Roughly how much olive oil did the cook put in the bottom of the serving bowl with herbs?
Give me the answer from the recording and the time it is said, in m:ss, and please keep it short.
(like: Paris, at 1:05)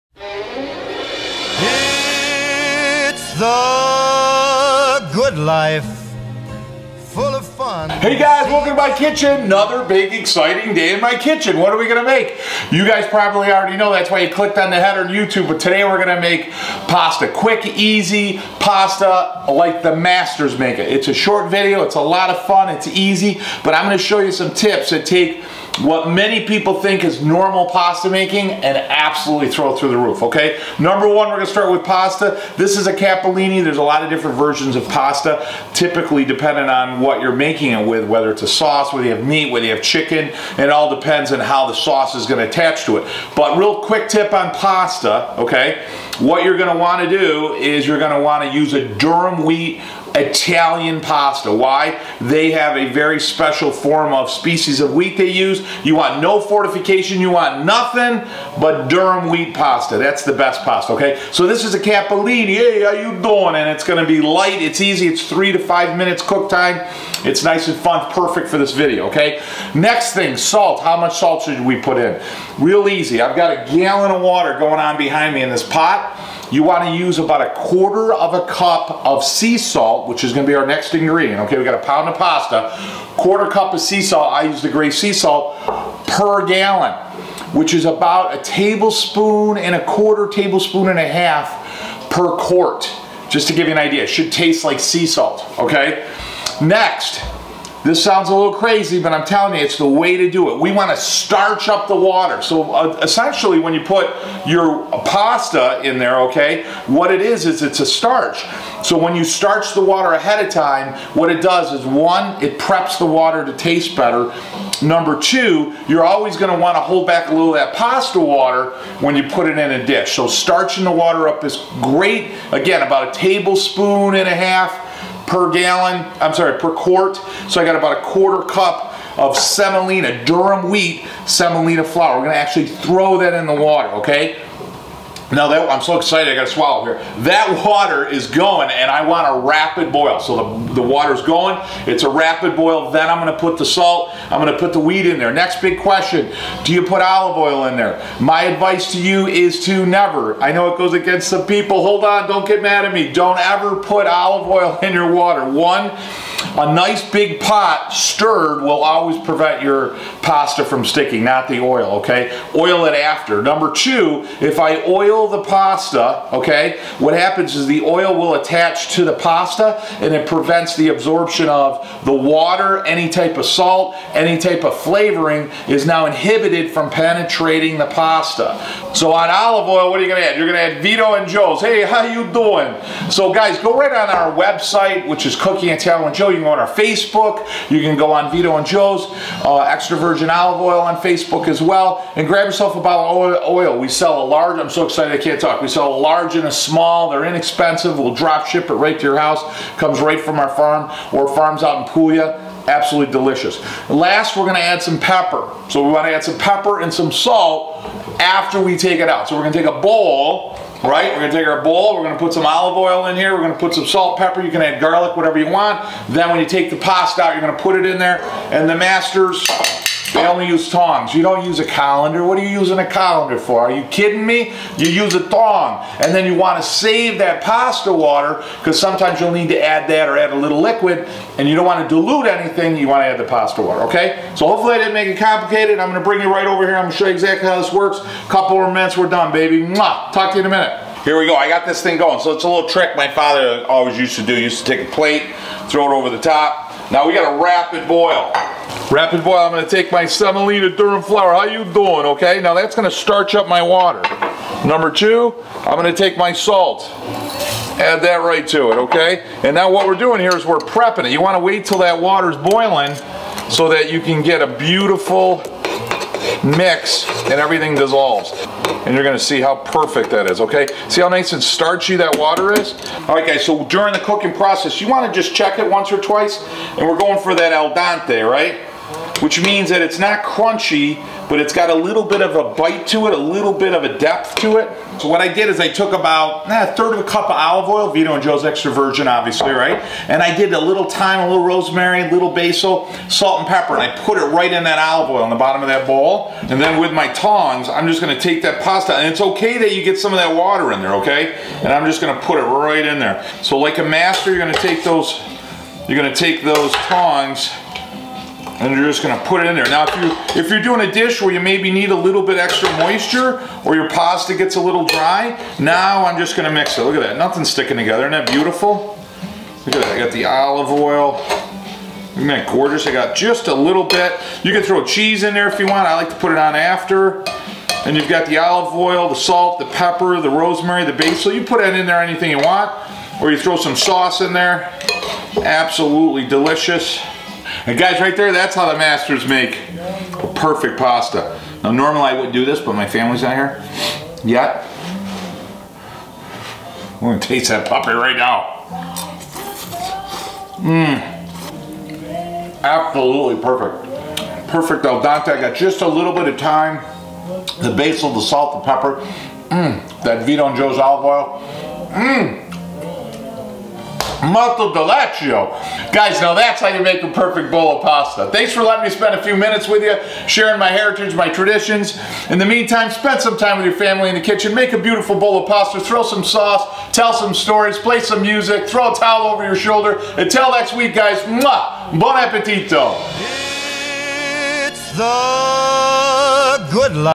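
a third of a cup, at 4:46.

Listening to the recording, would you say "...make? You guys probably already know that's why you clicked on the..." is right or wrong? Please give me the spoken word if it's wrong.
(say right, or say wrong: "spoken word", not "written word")
right.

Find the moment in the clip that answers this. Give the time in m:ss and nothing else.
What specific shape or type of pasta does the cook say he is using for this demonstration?
0:32.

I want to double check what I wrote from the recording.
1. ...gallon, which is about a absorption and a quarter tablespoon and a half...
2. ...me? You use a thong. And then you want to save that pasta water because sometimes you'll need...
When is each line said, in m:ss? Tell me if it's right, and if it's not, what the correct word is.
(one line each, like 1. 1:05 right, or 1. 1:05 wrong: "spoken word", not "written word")
1. 1:26 wrong: "tablespoon", not "absorption"
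2. 3:44 right.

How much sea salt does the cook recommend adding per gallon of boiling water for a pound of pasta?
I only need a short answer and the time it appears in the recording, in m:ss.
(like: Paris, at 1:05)
a quarter of a cup, at 1:17.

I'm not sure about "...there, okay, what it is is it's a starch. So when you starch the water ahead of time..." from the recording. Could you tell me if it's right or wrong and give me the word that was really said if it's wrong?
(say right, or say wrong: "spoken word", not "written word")
right.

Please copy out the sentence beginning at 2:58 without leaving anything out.
So on olive oil, what are you gonna add?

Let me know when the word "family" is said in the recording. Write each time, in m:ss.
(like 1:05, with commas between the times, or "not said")
5:42, 6:13.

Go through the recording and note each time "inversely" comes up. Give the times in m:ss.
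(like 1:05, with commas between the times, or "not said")
not said.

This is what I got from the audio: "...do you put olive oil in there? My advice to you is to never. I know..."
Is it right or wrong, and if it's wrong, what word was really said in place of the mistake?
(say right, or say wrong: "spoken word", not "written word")
right.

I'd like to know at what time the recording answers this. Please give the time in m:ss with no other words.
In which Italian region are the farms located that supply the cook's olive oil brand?
3:21.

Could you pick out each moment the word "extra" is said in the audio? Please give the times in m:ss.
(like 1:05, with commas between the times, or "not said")
3:09, 4:48, 5:12.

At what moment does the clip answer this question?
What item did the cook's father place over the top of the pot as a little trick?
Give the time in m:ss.
4:04.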